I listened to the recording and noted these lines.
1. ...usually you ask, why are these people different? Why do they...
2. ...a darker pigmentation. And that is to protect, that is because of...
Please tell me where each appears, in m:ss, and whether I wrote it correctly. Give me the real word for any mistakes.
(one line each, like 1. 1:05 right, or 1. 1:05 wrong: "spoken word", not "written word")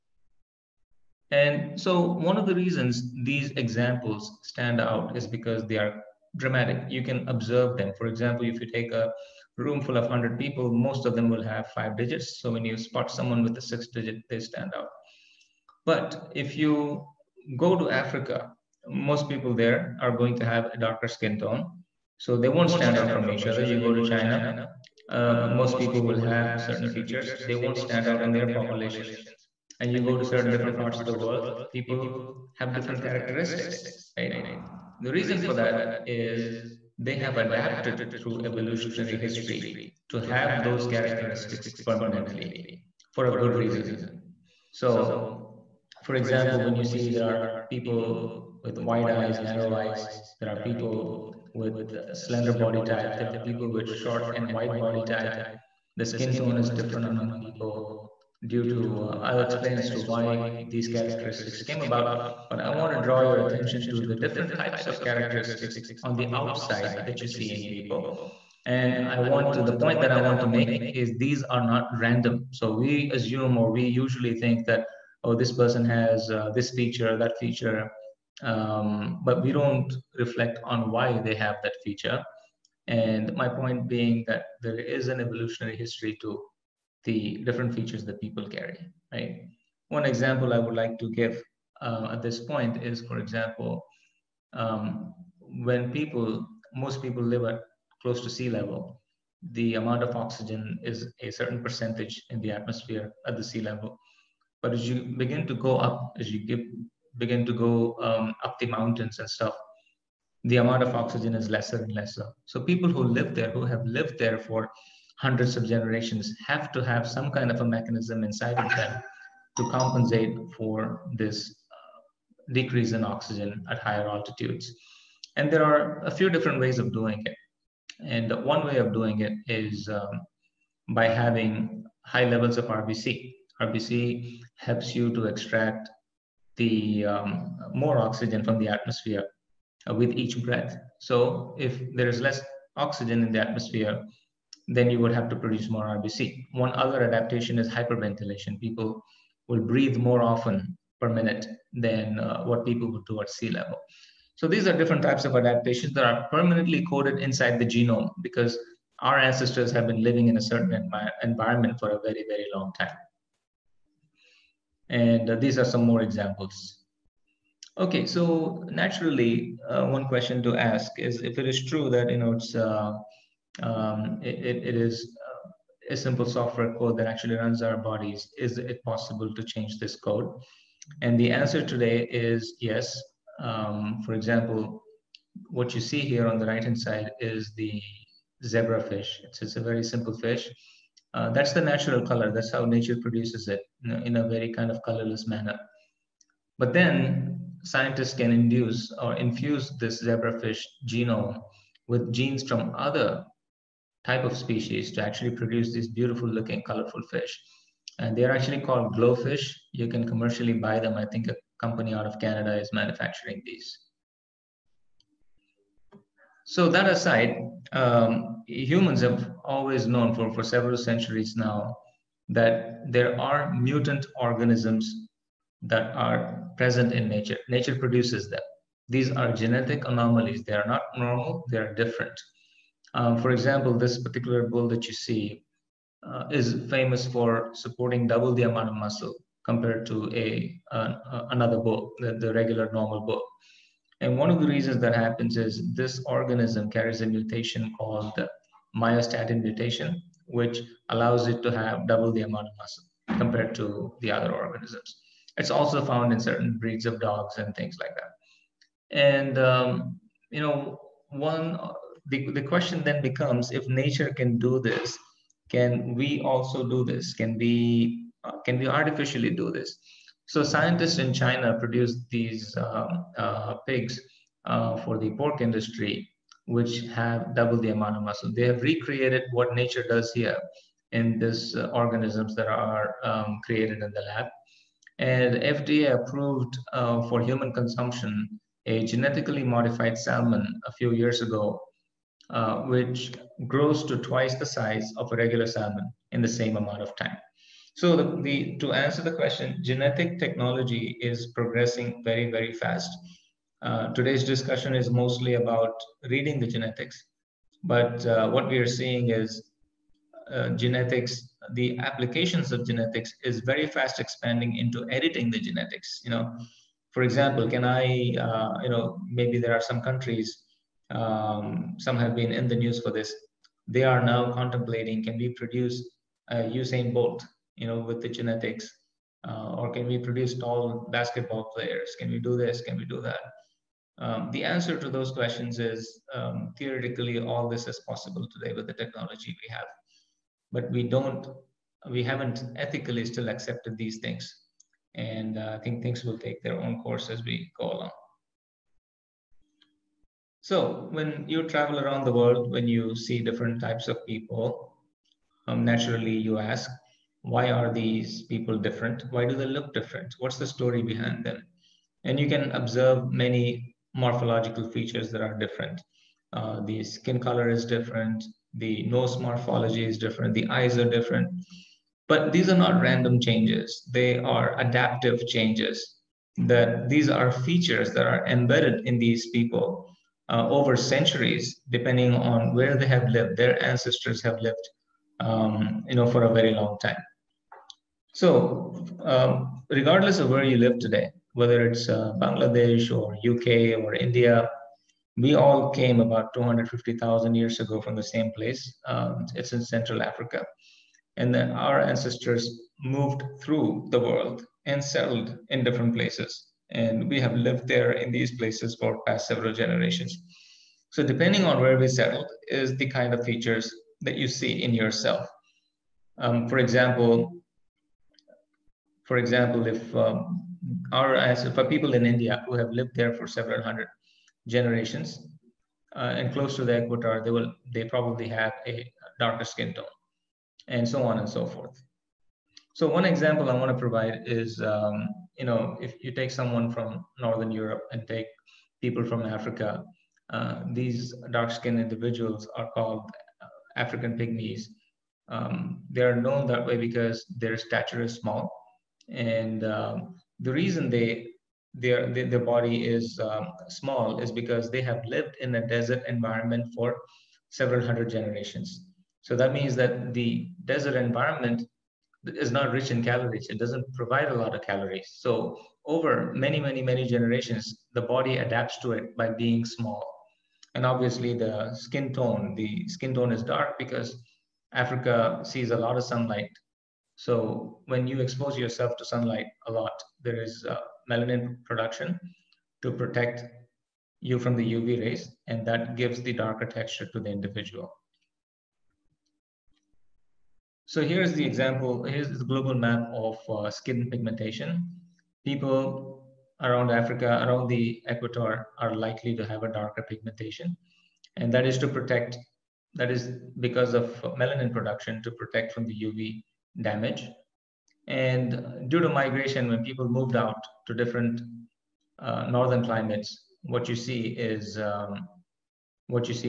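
1. 5:55 wrong: "naturally", not "usually"
2. 8:19 right.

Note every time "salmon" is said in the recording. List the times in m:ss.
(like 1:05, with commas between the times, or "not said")
4:49, 4:55.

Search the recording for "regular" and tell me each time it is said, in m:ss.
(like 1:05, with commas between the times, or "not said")
4:02, 4:55.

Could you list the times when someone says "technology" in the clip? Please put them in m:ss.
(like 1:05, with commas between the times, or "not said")
5:00, 5:38.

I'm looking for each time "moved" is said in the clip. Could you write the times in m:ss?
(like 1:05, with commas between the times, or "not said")
6:42, 8:30.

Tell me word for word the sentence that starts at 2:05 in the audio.
And there are a few different ways of doing it.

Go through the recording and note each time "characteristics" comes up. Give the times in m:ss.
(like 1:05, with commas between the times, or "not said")
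0:33, 0:40, 1:00, 1:05.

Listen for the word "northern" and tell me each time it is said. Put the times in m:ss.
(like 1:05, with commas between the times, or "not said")
7:17, 8:32.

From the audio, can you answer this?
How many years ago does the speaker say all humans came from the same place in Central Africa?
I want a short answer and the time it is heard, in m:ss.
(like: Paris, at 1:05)
250,000, at 6:36.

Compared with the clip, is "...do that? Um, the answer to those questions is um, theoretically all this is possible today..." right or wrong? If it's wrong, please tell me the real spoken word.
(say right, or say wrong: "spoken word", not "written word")
right.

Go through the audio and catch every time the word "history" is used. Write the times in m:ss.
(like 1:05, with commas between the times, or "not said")
0:39, 1:25.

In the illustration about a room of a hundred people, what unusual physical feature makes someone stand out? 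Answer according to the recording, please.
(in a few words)
six digit.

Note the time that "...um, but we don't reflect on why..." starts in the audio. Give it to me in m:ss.
1:18.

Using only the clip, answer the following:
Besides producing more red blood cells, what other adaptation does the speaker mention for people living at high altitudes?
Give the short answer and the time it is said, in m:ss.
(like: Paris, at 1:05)
hyperventilation, at 2:27.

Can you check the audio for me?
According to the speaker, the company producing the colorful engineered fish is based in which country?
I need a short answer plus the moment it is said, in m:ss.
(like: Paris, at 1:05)
Canada, at 3:32.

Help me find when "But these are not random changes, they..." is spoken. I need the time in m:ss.
6:12.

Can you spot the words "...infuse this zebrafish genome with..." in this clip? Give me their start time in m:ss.
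3:19.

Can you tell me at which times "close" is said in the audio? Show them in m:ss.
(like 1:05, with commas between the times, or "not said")
1:38, 7:06.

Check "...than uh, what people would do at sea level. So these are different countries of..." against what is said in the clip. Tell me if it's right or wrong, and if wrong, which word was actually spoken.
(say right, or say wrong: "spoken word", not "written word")
wrong: "types", not "countries".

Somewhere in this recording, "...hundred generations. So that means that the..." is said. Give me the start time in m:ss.
7:37.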